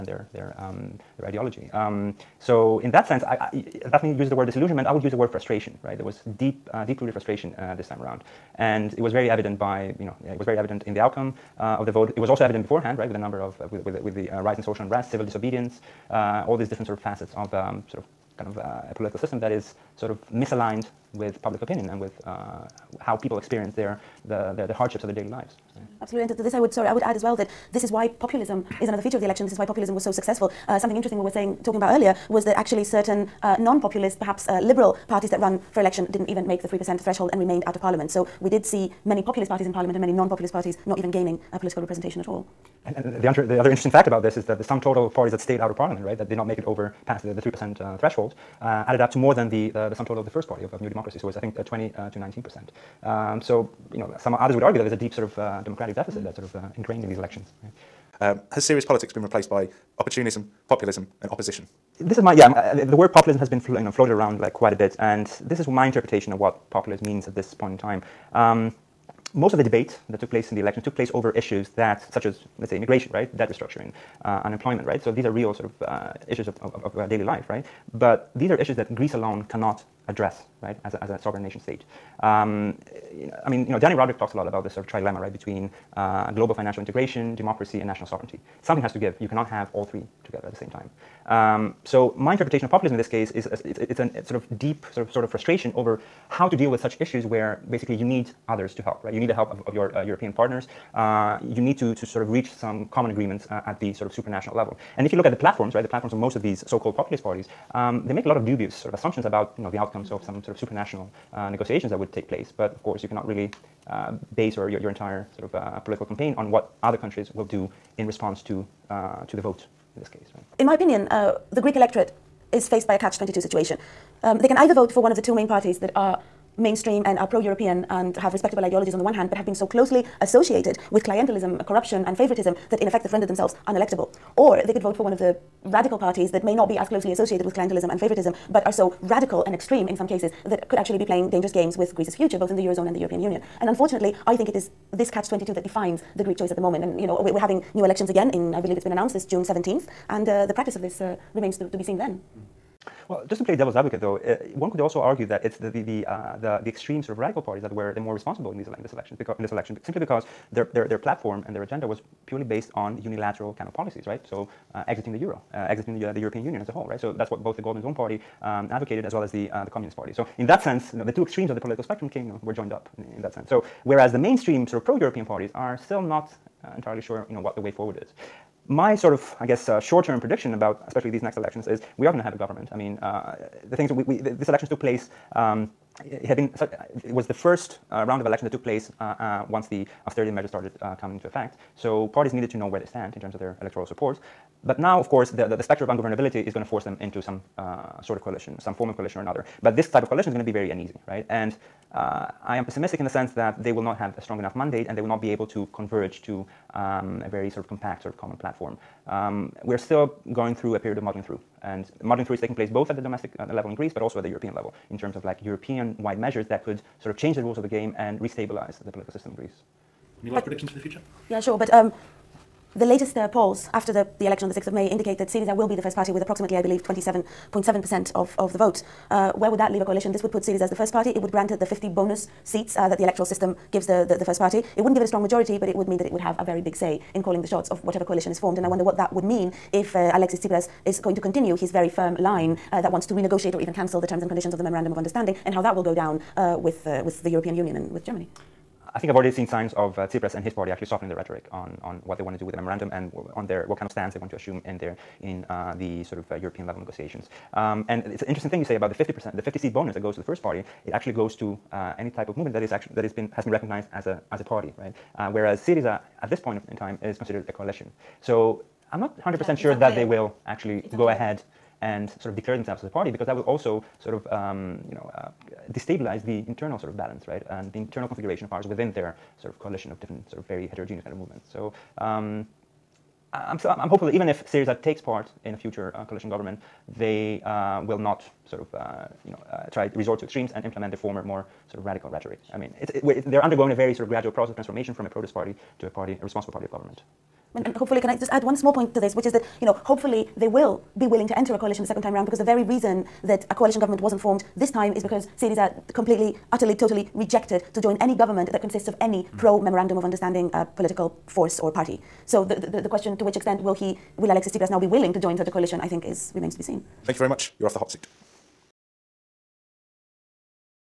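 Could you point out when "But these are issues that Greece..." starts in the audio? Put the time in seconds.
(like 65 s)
78 s.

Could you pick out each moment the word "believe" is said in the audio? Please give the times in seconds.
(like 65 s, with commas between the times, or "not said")
148 s, 226 s.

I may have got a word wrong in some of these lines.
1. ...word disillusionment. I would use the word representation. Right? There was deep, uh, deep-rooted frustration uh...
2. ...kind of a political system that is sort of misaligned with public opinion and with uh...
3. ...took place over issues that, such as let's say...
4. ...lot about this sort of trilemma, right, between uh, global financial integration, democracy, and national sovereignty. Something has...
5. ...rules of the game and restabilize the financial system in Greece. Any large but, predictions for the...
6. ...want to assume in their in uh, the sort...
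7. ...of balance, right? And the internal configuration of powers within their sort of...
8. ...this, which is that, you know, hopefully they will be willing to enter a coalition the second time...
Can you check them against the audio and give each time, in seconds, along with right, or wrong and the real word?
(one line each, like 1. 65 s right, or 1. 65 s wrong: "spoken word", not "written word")
1. 4 s wrong: "frustration", not "representation"
2. 18 s right
3. 70 s right
4. 84 s right
5. 217 s wrong: "political", not "financial"
6. 254 s right
7. 276 s right
8. 298 s right.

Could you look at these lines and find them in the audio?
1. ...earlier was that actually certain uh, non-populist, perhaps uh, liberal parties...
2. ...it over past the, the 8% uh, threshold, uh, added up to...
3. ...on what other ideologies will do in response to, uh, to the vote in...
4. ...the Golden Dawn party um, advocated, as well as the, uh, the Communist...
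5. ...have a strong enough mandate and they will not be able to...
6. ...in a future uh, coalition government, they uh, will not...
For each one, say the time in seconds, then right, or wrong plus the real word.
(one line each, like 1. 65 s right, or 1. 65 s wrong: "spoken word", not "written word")
1. 31 s right
2. 46 s wrong: "3", not "8"
3. 116 s wrong: "countries", not "ideologies"
4. 167 s right
5. 203 s right
6. 285 s right.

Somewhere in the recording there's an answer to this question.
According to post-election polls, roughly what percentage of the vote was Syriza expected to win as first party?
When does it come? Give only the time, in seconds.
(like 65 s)
226 s.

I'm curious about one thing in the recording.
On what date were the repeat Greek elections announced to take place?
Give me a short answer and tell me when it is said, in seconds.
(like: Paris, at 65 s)
June 17th, at 149 s.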